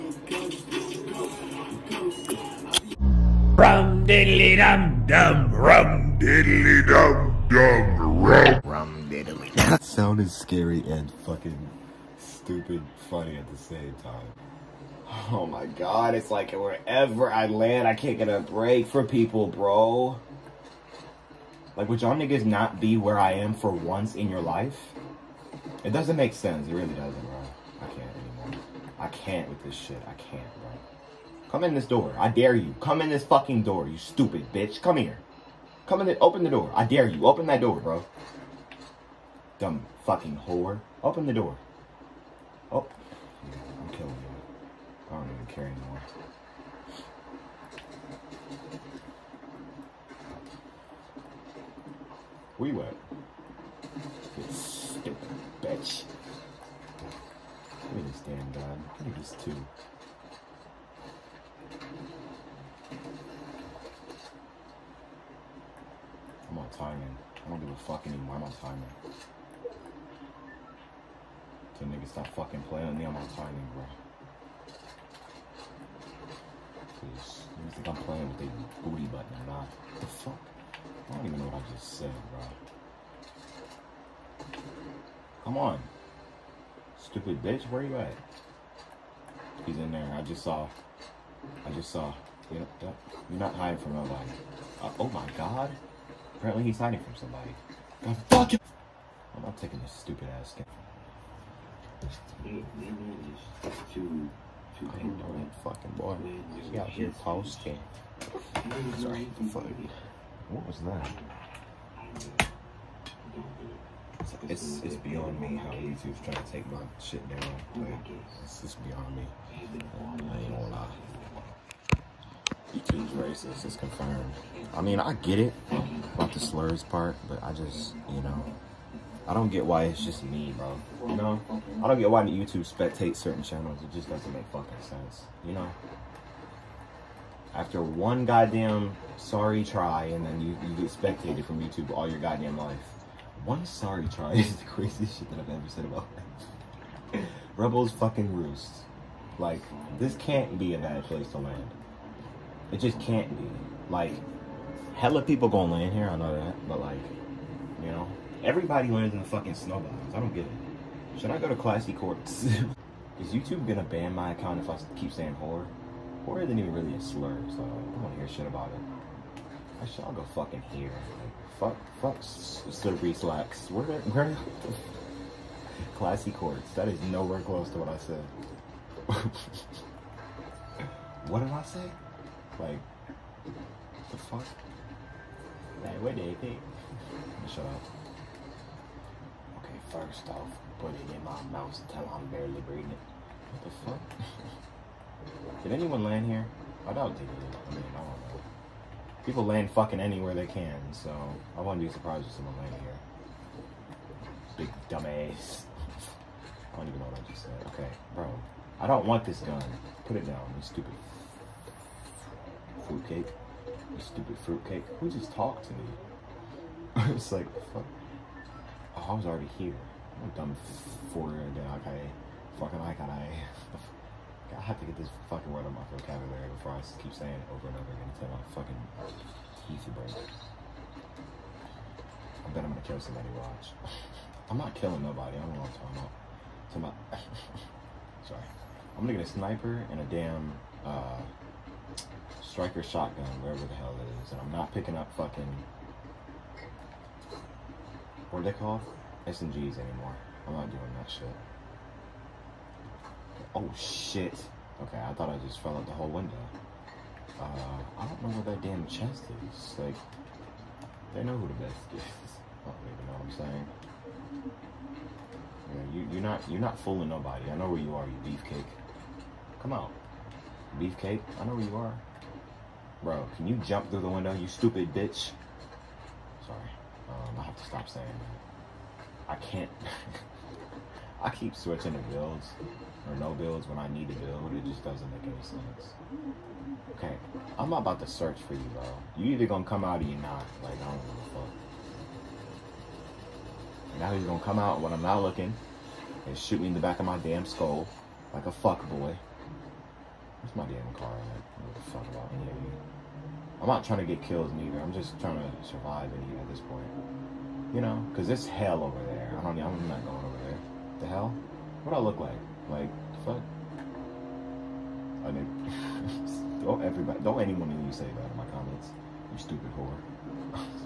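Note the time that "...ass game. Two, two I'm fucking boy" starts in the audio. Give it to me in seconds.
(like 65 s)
100 s.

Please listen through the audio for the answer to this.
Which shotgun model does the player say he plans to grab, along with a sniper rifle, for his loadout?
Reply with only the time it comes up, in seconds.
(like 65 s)
242 s.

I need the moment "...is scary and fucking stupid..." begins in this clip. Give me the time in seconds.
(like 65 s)
10 s.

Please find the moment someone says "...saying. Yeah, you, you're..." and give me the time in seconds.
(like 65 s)
263 s.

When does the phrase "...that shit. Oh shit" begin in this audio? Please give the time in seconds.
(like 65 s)
250 s.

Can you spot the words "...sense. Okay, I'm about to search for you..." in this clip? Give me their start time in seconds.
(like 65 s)
285 s.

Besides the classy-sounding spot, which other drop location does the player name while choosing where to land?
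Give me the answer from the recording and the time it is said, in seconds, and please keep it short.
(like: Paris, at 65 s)
Slippery Slacks, at 172 s.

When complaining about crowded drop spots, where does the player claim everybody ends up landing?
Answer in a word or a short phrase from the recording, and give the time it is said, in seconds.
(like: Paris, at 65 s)
Snowballs, at 159 s.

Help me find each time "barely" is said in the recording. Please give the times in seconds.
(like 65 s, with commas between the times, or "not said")
192 s.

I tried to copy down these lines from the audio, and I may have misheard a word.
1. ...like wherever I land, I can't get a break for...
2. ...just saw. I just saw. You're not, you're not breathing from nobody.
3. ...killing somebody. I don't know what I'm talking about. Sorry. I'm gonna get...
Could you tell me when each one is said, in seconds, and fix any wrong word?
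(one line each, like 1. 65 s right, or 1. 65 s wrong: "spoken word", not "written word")
1. 16 s right
2. 90 s wrong: "hiding", not "breathing"
3. 234 s wrong: "nobody", not "somebody".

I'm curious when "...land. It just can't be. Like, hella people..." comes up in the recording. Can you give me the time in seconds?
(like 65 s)
151 s.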